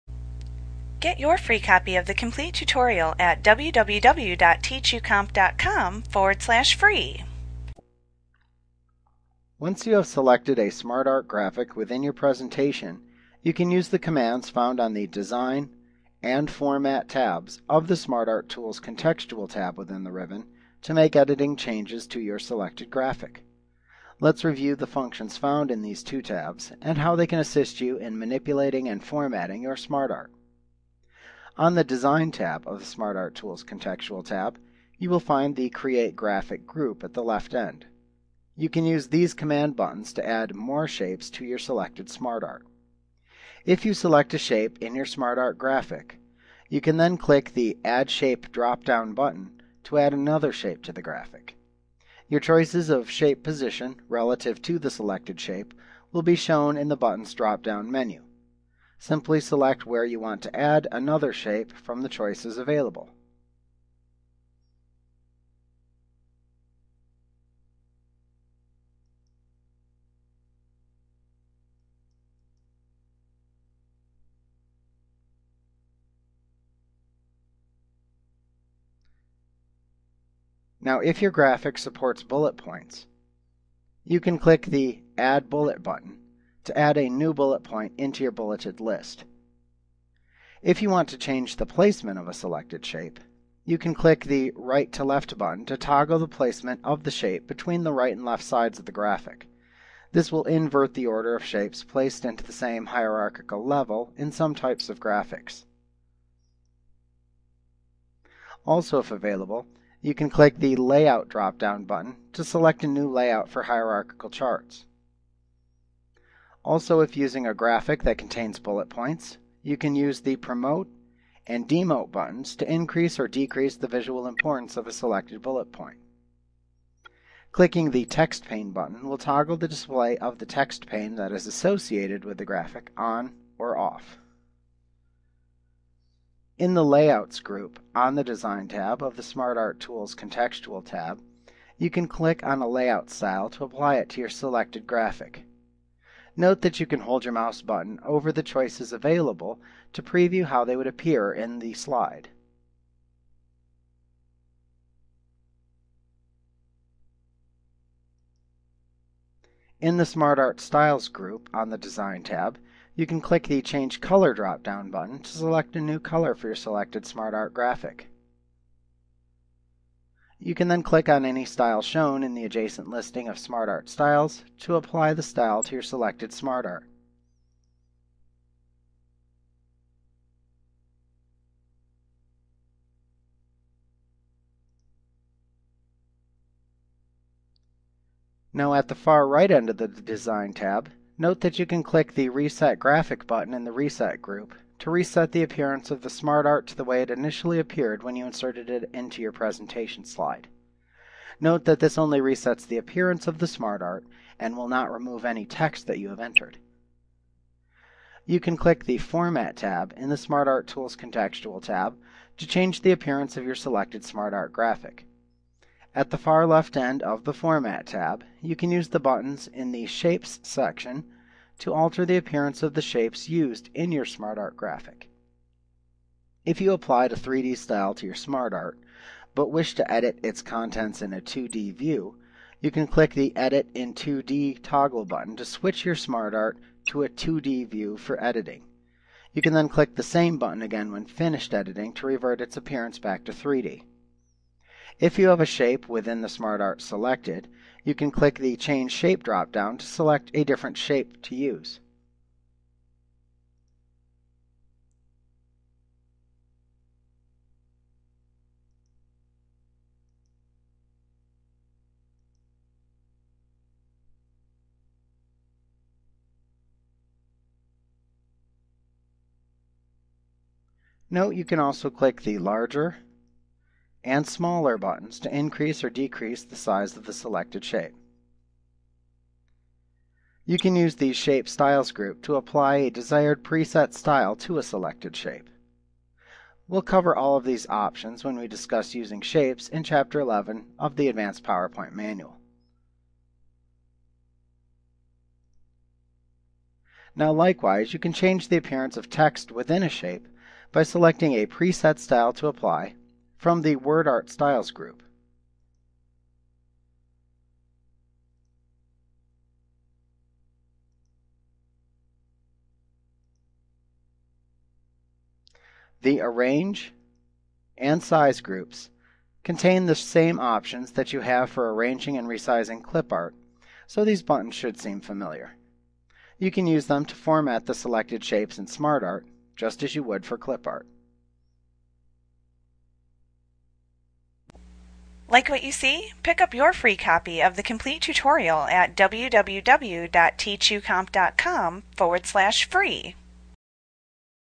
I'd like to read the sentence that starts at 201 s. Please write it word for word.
Note that this only resets the appearance of the SmartArt and will not remove any text that you have entered.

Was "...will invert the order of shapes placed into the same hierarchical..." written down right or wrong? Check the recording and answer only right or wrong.
right.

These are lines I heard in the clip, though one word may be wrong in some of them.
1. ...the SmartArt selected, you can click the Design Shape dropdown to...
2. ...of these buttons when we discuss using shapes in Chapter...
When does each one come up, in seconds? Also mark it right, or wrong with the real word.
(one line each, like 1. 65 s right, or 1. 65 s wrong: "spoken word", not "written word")
1. 246 s wrong: "Change", not "Design"
2. 287 s wrong: "options", not "buttons".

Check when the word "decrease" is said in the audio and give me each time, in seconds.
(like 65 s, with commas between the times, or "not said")
123 s, 275 s.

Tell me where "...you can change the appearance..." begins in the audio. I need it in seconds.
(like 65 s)
297 s.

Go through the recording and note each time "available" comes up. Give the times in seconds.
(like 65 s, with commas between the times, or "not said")
62 s, 109 s, 148 s.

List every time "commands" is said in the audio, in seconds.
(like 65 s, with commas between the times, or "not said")
13 s, 39 s.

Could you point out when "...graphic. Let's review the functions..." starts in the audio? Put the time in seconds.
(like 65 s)
22 s.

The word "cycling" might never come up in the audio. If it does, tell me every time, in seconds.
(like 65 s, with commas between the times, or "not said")
not said.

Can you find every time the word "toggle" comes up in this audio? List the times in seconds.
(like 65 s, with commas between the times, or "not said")
95 s, 129 s, 234 s.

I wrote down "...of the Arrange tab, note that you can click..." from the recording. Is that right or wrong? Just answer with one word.
wrong.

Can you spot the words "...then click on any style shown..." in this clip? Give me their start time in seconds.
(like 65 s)
170 s.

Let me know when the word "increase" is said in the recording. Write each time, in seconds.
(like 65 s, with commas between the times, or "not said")
122 s, 275 s.